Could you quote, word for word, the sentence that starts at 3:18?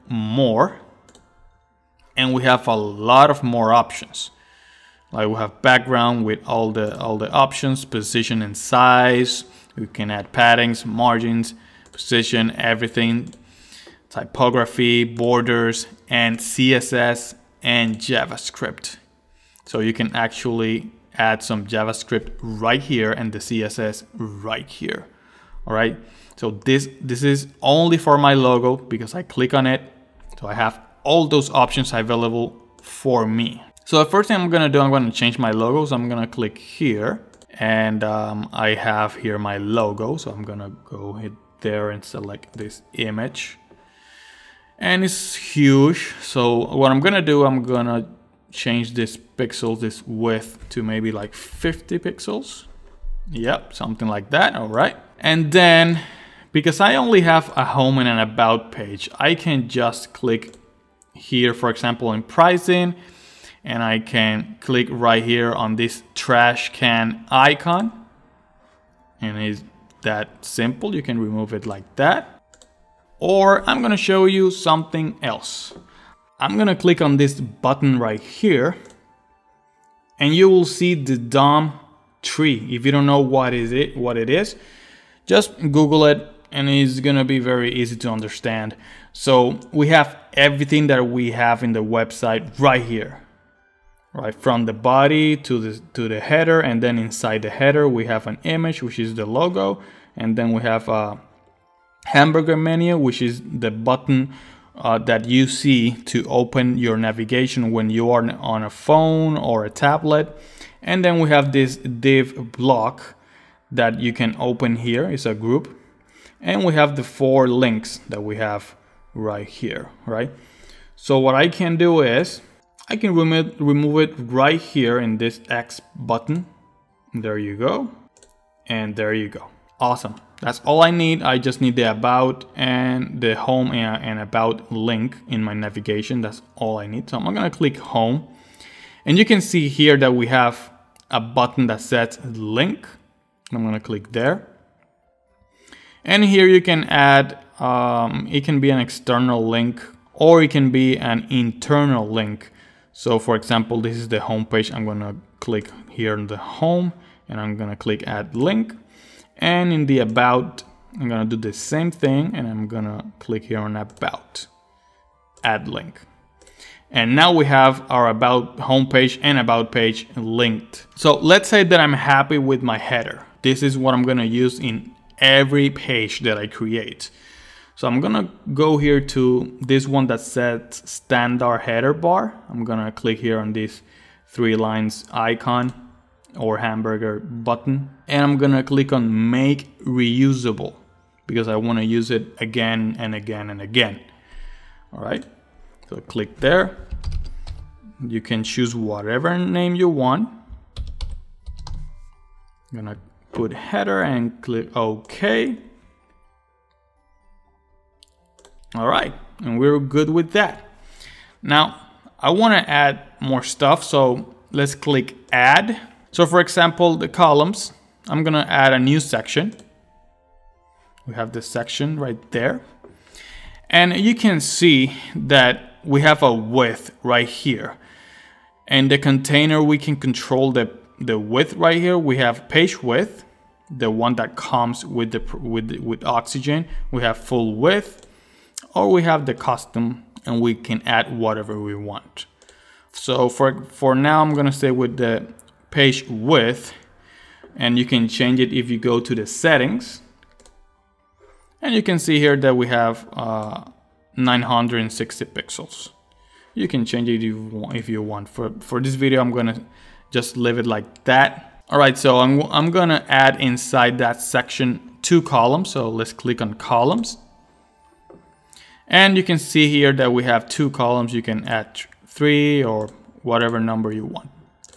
You can choose whatever name you want.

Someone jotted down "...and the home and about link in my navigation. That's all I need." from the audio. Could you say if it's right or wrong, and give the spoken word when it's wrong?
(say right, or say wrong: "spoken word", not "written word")
right.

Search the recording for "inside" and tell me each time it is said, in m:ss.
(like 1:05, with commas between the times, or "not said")
1:36, 4:23.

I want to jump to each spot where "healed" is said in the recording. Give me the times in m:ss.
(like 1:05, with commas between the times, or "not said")
not said.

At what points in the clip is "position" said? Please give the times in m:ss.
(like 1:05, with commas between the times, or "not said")
0:07, 0:11.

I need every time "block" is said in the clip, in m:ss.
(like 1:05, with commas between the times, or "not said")
1:52.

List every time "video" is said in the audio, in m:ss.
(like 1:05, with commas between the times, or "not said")
4:18.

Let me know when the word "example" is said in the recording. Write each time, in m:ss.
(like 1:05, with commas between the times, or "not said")
1:01, 2:33, 3:36.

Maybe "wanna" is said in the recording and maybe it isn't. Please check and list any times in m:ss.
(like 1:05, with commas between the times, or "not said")
3:11, 3:32.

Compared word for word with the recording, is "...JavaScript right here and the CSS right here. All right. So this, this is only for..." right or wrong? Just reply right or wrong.
right.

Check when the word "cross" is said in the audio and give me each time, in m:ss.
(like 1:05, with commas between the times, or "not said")
not said.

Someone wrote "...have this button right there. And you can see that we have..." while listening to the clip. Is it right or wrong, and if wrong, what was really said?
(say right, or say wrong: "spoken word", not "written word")
wrong: "section", not "button".